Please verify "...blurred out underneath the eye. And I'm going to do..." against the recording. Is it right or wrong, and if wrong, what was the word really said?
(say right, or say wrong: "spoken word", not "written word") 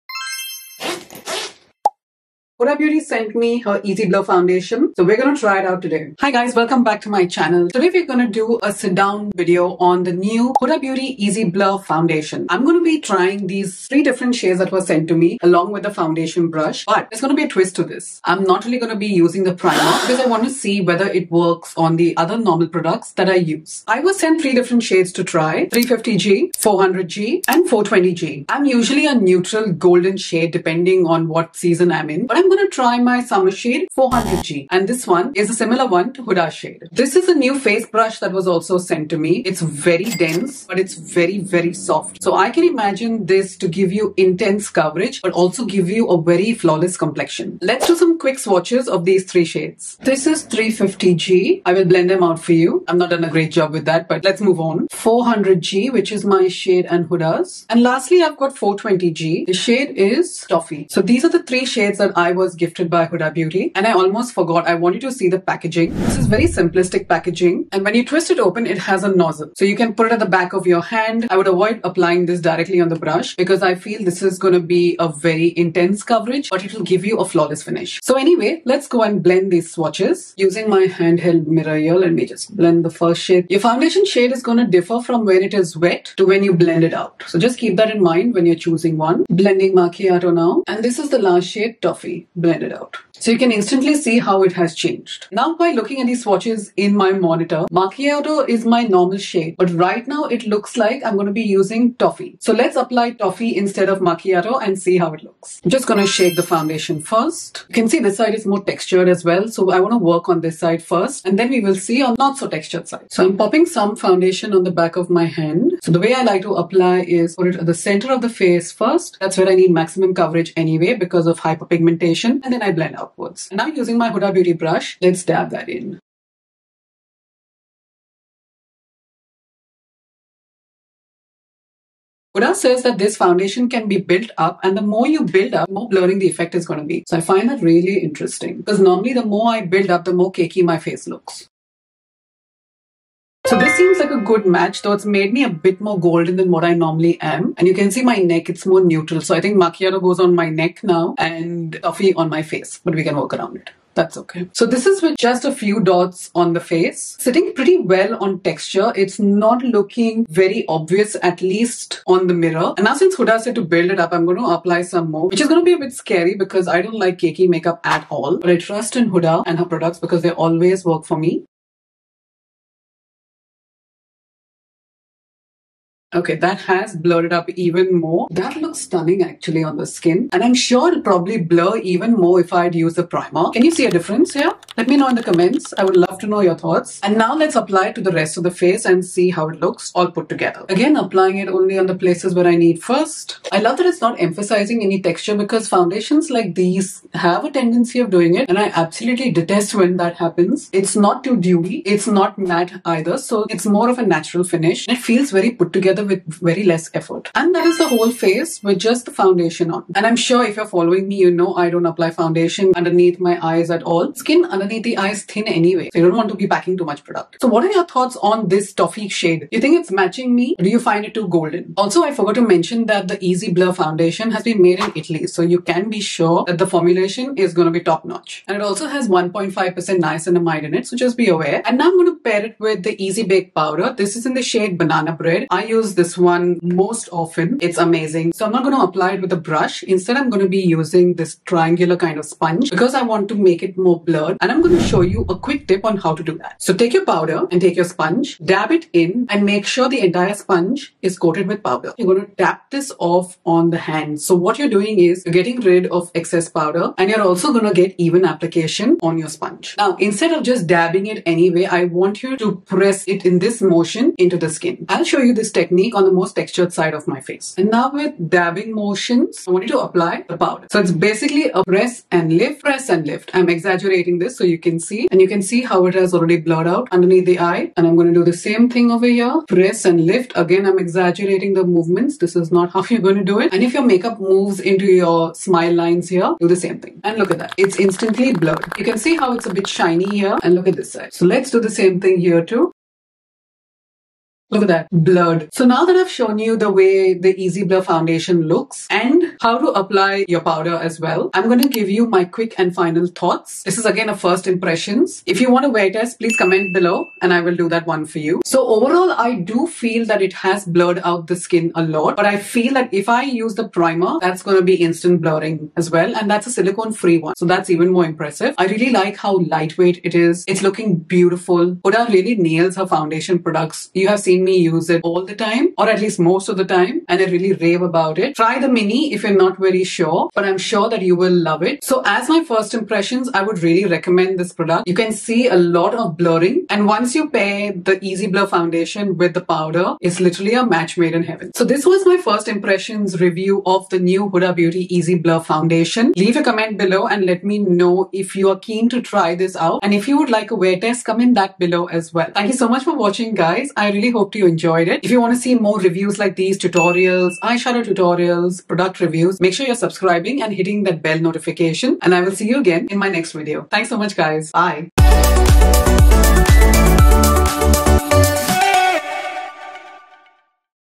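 right.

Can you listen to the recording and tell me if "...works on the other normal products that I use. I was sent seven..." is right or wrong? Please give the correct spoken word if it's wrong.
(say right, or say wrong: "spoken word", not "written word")
wrong: "three", not "seven".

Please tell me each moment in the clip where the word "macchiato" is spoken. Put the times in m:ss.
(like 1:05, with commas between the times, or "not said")
1:29, 1:37, 1:43, 2:29.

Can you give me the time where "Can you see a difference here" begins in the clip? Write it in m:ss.
3:03.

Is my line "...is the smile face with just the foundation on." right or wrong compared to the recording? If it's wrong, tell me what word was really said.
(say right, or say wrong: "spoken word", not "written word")
wrong: "whole", not "smile".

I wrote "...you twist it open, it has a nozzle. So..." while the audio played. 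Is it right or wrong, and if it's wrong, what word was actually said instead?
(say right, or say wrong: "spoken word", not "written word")
right.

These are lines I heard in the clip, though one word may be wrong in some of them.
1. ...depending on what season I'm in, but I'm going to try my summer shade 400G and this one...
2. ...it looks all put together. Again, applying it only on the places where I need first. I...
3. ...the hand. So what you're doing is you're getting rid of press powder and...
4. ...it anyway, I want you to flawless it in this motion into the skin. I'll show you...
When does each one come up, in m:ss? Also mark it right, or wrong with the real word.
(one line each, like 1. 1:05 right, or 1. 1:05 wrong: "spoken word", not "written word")
1. 0:30 right
2. 3:09 right
3. 4:13 wrong: "excess", not "press"
4. 4:21 wrong: "press", not "flawless".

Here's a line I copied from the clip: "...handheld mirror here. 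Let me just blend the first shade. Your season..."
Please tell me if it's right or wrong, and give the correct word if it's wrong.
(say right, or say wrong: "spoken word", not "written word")
wrong: "foundation", not "season".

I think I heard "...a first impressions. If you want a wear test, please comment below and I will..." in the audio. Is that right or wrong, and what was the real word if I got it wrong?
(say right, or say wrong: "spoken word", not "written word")
right.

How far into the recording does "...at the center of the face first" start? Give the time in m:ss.
1:57.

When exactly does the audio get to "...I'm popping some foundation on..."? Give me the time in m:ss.
1:53.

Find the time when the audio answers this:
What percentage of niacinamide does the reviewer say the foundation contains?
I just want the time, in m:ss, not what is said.
3:49.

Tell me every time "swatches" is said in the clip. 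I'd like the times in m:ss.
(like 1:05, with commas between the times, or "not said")
0:48, 1:19, 1:36.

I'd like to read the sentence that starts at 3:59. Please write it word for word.
Instead, I'm going to be using this triangular kind of sponge because I want to make it more blurred.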